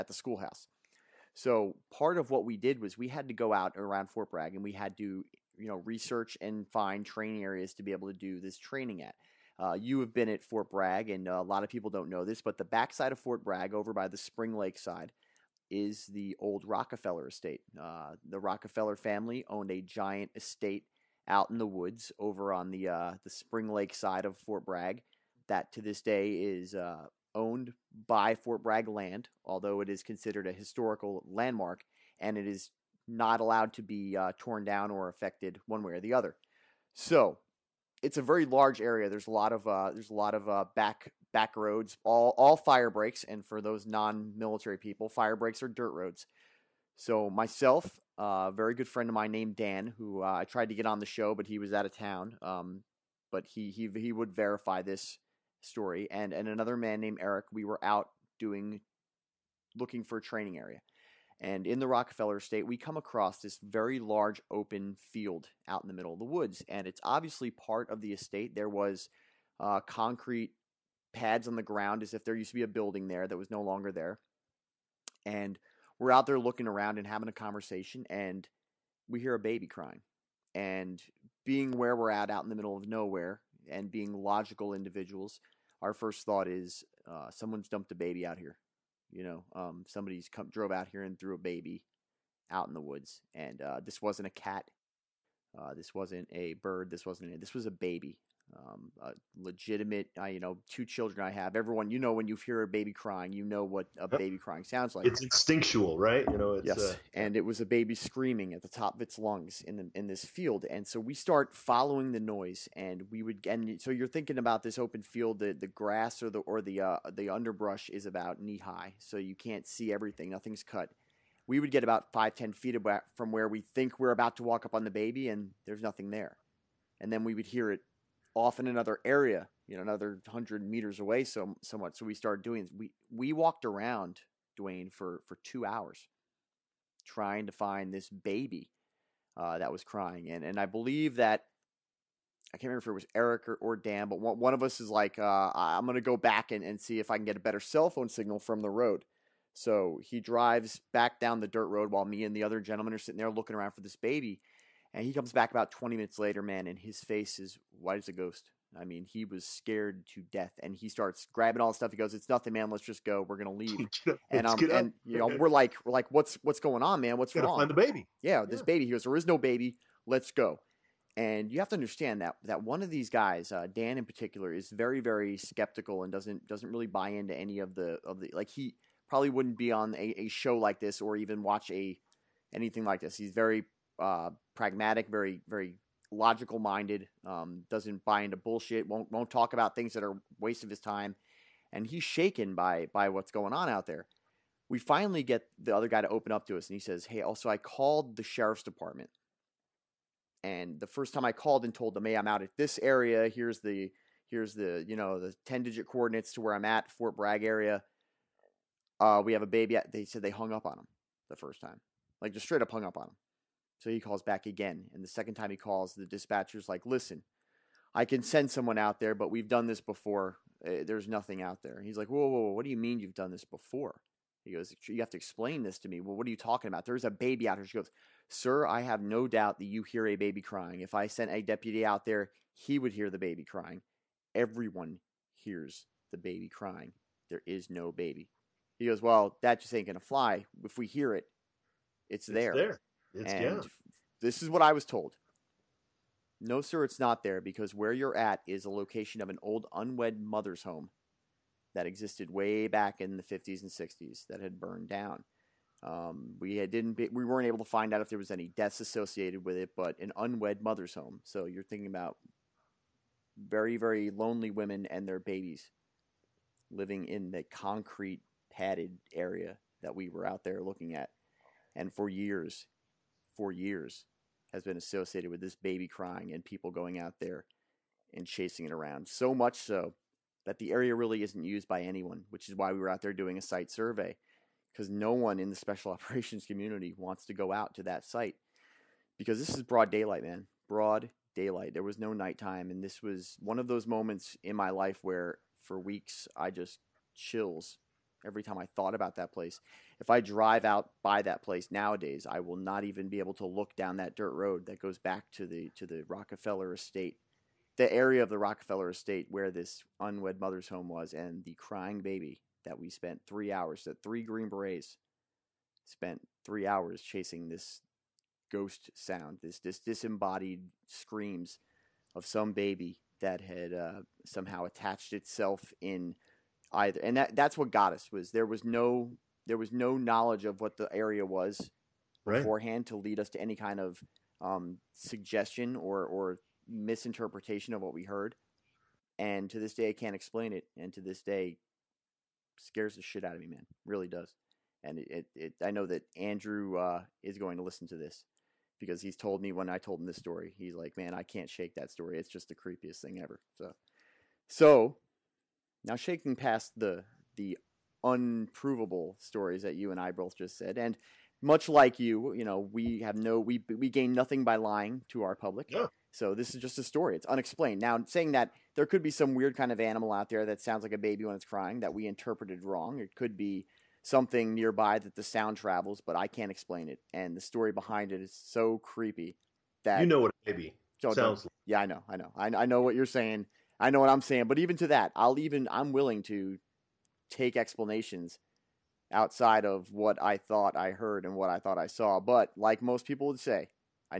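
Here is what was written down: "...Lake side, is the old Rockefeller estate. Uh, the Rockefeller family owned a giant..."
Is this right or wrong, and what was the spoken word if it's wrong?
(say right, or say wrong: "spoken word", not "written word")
right.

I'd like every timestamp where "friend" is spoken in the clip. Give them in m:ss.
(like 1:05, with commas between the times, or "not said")
0:48.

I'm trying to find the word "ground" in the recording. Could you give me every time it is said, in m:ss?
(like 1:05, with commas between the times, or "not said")
1:11.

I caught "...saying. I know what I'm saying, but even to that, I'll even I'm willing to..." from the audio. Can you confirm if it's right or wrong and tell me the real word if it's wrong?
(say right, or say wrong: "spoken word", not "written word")
right.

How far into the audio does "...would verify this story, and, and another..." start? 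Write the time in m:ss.
0:54.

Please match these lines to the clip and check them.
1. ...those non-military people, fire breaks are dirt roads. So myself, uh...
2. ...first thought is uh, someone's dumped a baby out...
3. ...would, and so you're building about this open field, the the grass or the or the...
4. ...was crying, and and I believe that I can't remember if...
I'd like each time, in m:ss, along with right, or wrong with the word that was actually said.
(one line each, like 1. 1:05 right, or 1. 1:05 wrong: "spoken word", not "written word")
1. 0:43 right
2. 1:25 right
3. 1:53 wrong: "thinking", not "building"
4. 2:19 right.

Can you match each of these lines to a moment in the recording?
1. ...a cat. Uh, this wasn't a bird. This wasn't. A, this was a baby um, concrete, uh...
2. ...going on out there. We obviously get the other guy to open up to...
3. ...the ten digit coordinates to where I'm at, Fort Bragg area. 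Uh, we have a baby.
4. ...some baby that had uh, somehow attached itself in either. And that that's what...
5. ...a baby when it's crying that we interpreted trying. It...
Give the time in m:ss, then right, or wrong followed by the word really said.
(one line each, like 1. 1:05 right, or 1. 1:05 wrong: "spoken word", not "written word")
1. 1:34 wrong: "legitimate", not "concrete"
2. 3:13 wrong: "finally", not "obviously"
3. 3:25 right
4. 5:22 right
5. 6:10 wrong: "wrong", not "trying".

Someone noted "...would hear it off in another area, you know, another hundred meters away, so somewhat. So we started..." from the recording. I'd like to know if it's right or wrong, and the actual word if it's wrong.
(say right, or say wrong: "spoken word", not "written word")
right.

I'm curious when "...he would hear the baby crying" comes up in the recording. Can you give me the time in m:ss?
3:52.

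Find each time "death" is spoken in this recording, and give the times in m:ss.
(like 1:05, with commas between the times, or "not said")
2:40, 4:18.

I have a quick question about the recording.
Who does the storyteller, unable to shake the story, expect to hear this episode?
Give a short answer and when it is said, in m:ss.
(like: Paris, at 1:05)
Andrew, at 5:46.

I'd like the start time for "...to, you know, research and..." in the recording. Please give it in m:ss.
0:04.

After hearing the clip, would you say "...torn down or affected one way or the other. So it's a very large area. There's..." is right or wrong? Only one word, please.
right.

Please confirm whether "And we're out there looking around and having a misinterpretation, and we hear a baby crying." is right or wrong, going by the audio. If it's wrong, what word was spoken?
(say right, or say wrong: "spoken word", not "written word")
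wrong: "conversation", not "misinterpretation".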